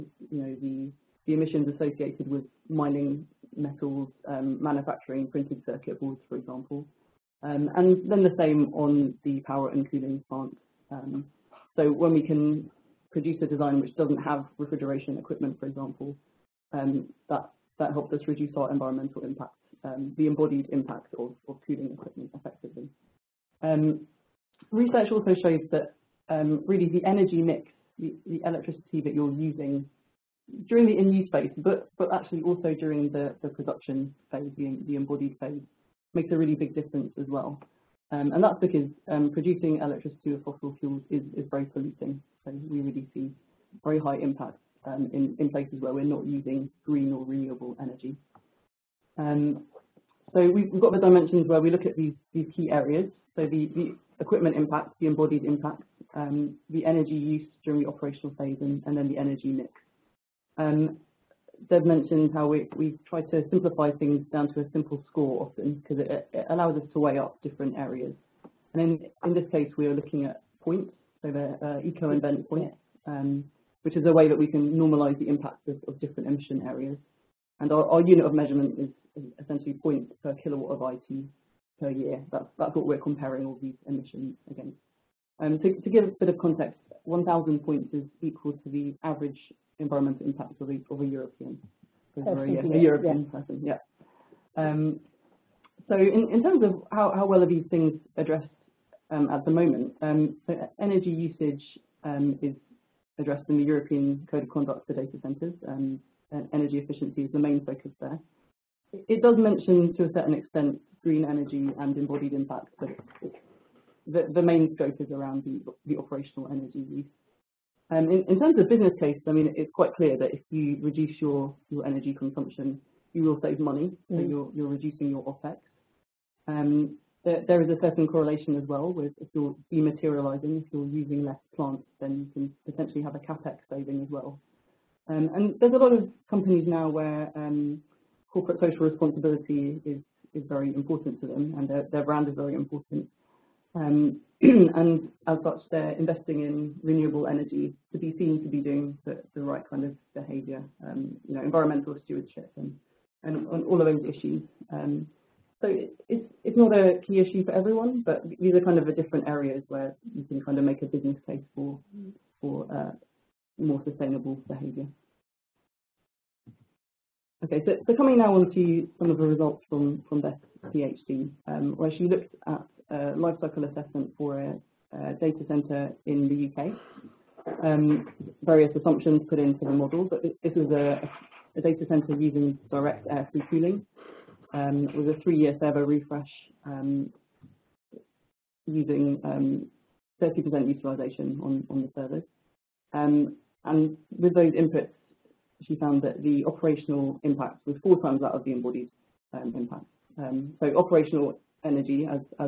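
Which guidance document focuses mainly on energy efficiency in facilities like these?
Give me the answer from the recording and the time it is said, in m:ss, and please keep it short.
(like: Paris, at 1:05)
European Code of Conduct, at 1:43.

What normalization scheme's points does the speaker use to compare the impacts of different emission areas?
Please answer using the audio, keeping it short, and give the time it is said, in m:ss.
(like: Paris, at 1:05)
ecoinvent, at 1:11.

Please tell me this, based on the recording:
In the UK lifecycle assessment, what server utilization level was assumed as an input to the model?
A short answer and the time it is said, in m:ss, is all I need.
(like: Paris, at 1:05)
30%, at 3:10.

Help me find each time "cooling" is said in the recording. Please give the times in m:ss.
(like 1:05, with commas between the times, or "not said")
0:09, 0:21, 3:03.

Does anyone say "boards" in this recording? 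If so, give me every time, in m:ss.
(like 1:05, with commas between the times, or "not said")
0:06.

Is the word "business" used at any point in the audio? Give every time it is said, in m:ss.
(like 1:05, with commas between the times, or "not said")
1:58, 2:40.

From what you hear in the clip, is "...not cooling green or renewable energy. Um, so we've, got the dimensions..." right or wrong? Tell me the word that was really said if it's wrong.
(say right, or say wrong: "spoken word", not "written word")
wrong: "using", not "cooling".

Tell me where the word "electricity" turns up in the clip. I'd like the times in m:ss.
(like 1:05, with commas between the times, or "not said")
0:28, 0:39.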